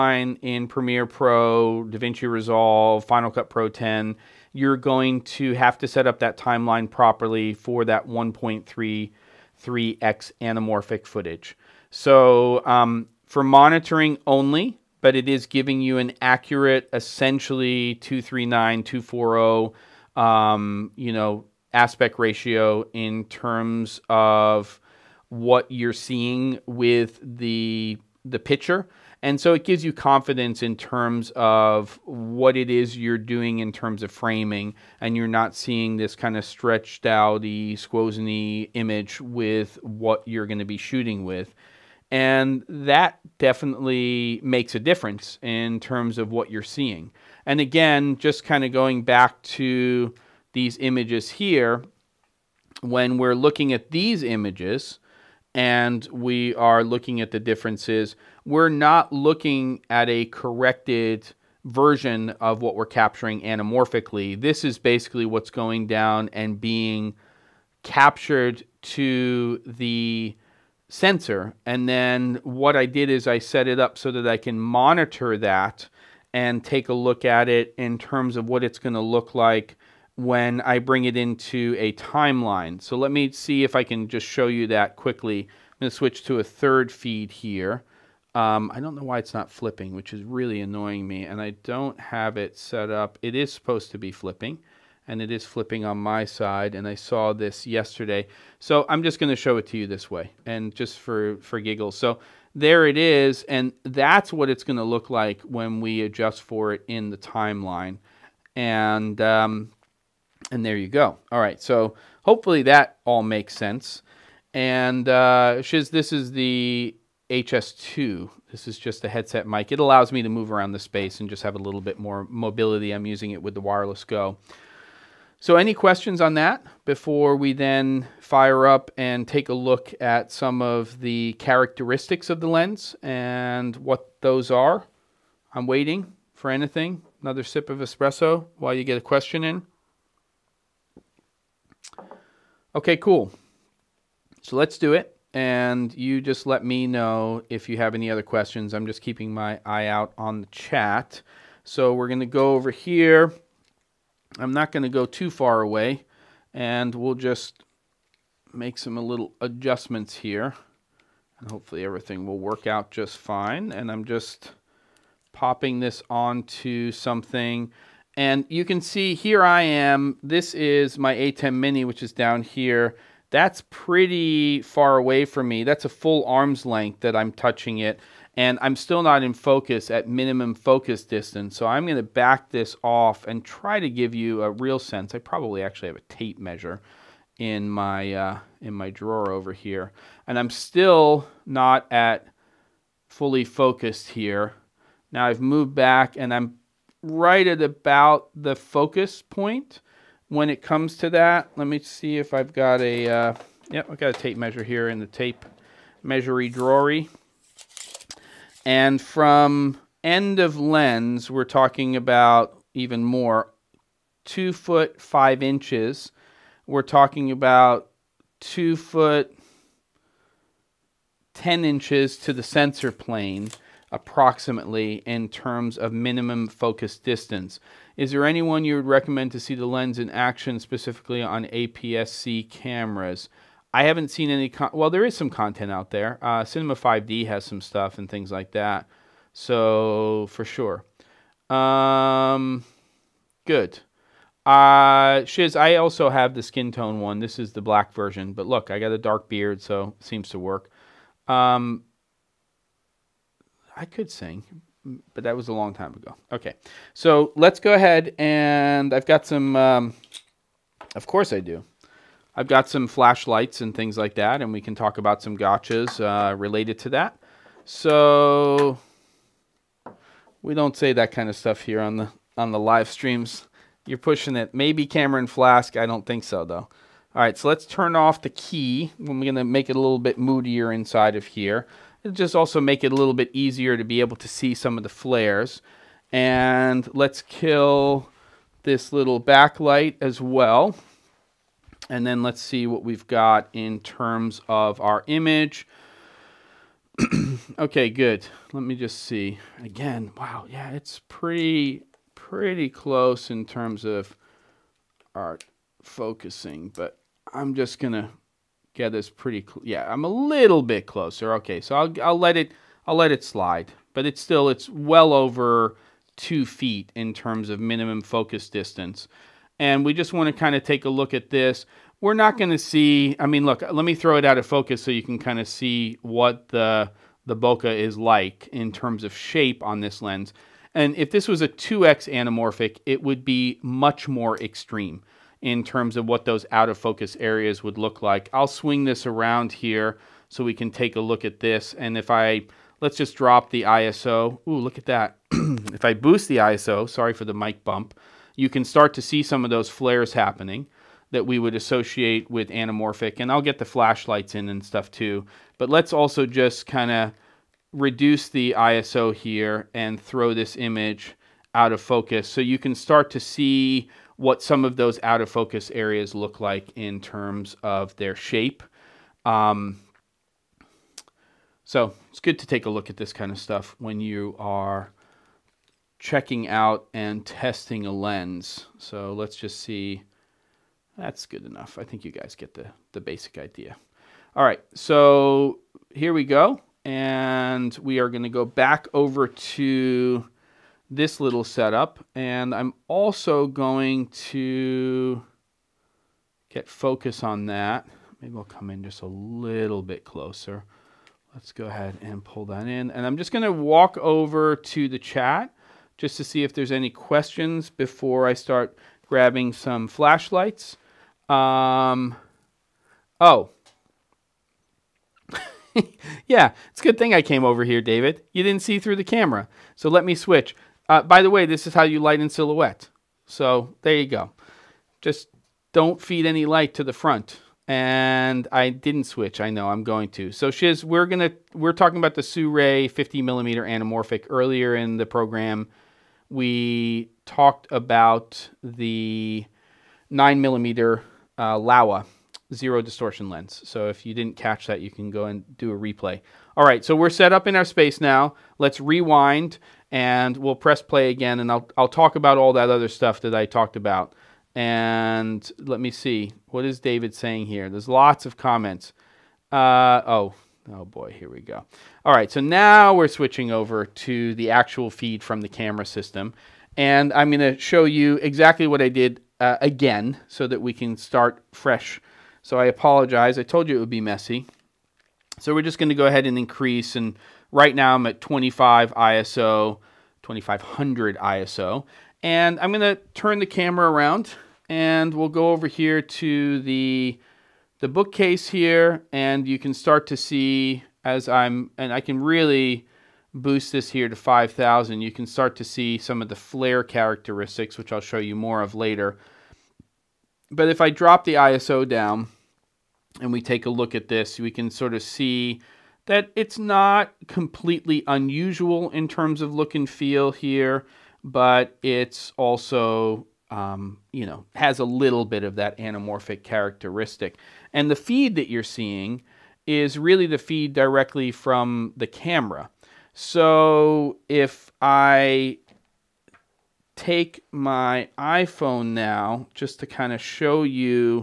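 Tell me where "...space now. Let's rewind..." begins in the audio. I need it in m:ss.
7:27.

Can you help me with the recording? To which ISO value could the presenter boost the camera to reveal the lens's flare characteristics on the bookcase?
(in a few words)
5000.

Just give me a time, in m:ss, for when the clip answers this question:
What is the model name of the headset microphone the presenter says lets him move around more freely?
1:57.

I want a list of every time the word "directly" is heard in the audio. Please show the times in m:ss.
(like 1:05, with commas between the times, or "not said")
8:40.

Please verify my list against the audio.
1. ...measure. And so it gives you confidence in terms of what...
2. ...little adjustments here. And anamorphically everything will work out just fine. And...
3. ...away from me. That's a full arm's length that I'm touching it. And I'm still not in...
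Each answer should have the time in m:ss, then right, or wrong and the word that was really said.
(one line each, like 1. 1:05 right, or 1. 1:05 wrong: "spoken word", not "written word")
1. 0:28 wrong: "picture", not "measure"
2. 2:38 wrong: "hopefully", not "anamorphically"
3. 2:54 right.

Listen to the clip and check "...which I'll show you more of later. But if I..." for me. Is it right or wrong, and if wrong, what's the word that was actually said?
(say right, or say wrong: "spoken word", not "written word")
right.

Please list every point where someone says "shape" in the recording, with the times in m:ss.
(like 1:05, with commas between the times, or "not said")
5:29, 6:08.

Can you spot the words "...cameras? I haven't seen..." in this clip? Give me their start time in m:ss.
3:52.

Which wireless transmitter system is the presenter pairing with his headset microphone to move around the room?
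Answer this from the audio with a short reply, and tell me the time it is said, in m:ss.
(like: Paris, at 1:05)
Wireless Go, at 2:03.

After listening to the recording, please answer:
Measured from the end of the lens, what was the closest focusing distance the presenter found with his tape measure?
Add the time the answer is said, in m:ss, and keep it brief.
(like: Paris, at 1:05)
2 foot 5 inches, at 3:34.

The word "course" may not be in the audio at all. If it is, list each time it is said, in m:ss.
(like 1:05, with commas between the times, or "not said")
4:21.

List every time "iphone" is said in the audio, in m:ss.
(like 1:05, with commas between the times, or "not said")
8:48.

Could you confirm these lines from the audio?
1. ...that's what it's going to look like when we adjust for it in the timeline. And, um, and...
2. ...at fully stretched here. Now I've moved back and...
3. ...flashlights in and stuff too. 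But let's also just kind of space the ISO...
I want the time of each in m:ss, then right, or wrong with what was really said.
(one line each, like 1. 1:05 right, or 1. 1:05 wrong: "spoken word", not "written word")
1. 1:43 right
2. 3:11 wrong: "focused", not "stretched"
3. 5:53 wrong: "reduce", not "space".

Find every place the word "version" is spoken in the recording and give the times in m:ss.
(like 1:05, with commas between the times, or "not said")
1:01, 4:07.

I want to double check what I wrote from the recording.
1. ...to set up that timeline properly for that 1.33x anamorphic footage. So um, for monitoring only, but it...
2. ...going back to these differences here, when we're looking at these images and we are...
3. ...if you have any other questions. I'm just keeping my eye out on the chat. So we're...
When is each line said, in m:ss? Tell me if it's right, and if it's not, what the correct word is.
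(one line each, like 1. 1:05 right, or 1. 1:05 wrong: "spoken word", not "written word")
1. 0:05 right
2. 0:48 wrong: "images", not "differences"
3. 2:27 right.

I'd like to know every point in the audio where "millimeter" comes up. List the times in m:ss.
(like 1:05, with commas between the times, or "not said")
7:13, 7:20.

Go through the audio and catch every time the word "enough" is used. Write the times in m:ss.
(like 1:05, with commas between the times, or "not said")
6:21.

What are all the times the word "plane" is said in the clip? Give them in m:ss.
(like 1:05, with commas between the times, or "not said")
3:42.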